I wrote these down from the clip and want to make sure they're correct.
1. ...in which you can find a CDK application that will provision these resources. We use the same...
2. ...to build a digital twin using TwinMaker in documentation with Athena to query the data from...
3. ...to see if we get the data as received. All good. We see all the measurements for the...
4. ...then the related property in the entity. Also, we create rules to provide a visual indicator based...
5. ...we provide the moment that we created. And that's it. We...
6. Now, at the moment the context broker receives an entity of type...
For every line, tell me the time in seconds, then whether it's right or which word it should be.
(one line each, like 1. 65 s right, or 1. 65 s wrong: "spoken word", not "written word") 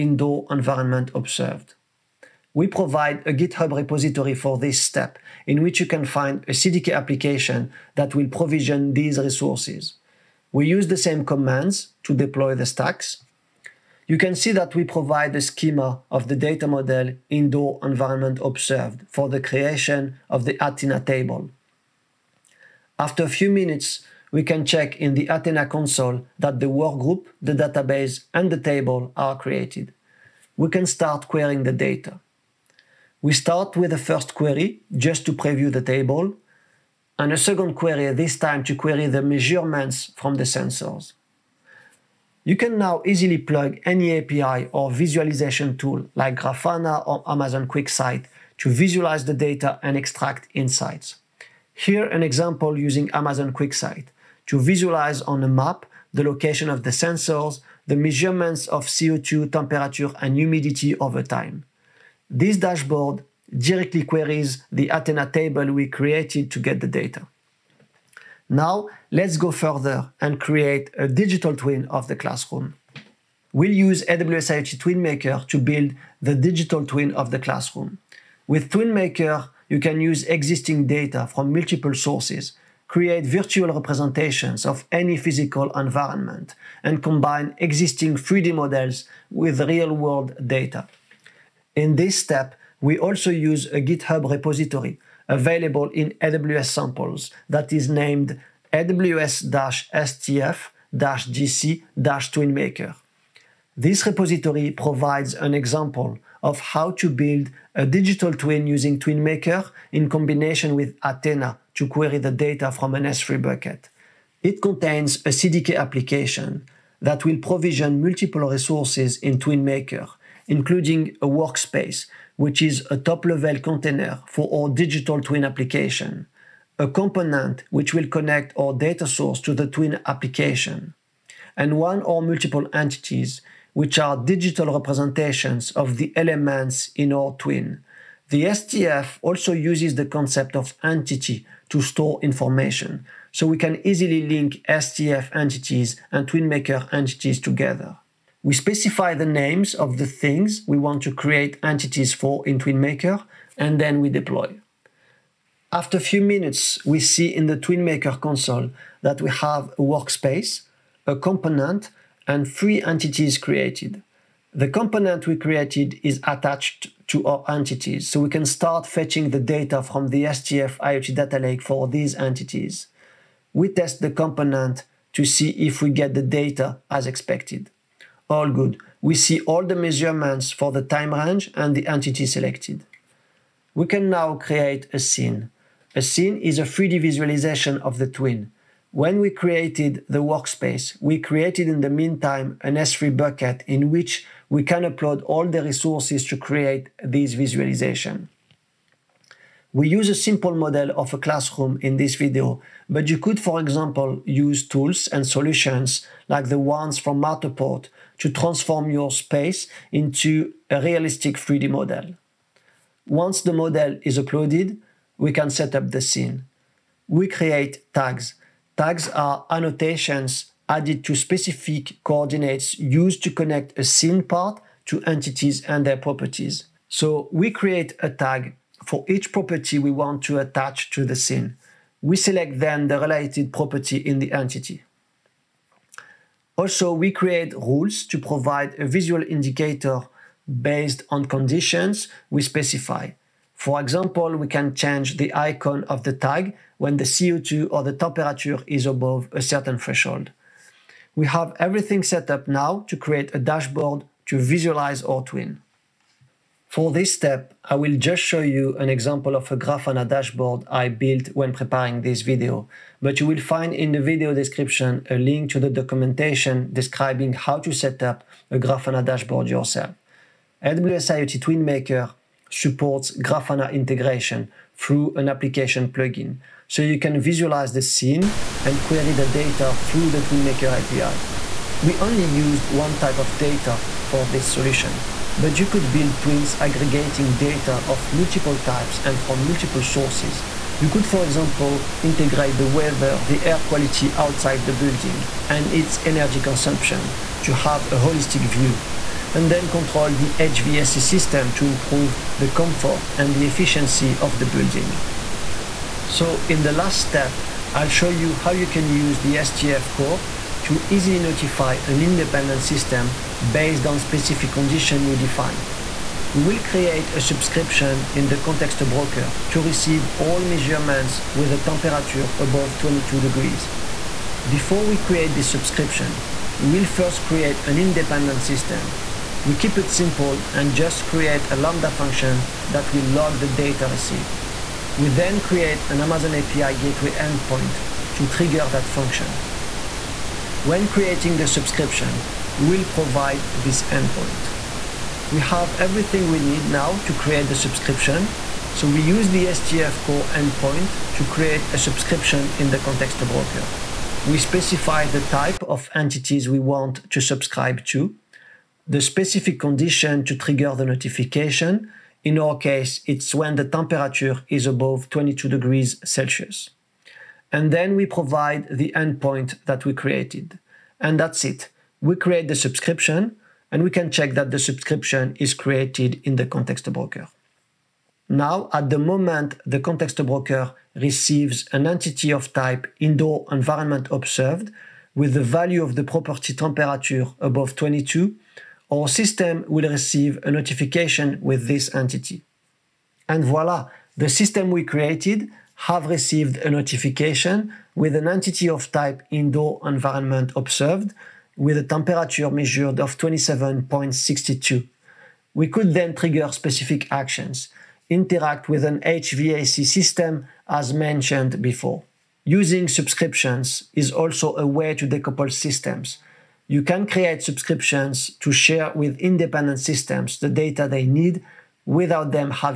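1. 5 s right
2. 106 s wrong: "combination", not "documentation"
3. 175 s wrong: "expected", not "received"
4. 232 s right
5. 367 s wrong: "endpoint", not "moment"
6. 378 s right.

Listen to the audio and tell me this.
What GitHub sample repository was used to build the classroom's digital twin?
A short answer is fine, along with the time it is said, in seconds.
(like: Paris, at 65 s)
aws-stf-gc-twinmaker, at 98 s.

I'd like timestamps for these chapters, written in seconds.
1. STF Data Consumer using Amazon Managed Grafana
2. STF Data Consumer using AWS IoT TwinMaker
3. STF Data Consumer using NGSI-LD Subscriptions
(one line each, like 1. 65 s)
1. 255 s
2. 75 s
3. 310 s.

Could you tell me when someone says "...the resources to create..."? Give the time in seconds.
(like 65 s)
195 s.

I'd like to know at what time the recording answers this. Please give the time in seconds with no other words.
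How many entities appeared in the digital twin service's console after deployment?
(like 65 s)
162 s.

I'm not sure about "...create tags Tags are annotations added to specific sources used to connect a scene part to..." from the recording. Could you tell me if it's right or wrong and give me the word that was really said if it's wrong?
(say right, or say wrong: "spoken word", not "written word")
wrong: "coordinates", not "sources".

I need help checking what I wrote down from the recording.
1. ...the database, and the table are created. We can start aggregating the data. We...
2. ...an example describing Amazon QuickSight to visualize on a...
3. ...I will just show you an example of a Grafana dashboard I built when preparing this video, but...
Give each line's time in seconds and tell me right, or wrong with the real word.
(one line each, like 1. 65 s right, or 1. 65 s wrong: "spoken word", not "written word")
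1. 27 s wrong: "querying", not "aggregating"
2. 52 s wrong: "using", not "describing"
3. 257 s right.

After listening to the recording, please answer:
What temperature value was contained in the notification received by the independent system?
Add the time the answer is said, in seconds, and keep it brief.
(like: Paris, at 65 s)
27.62, at 403 s.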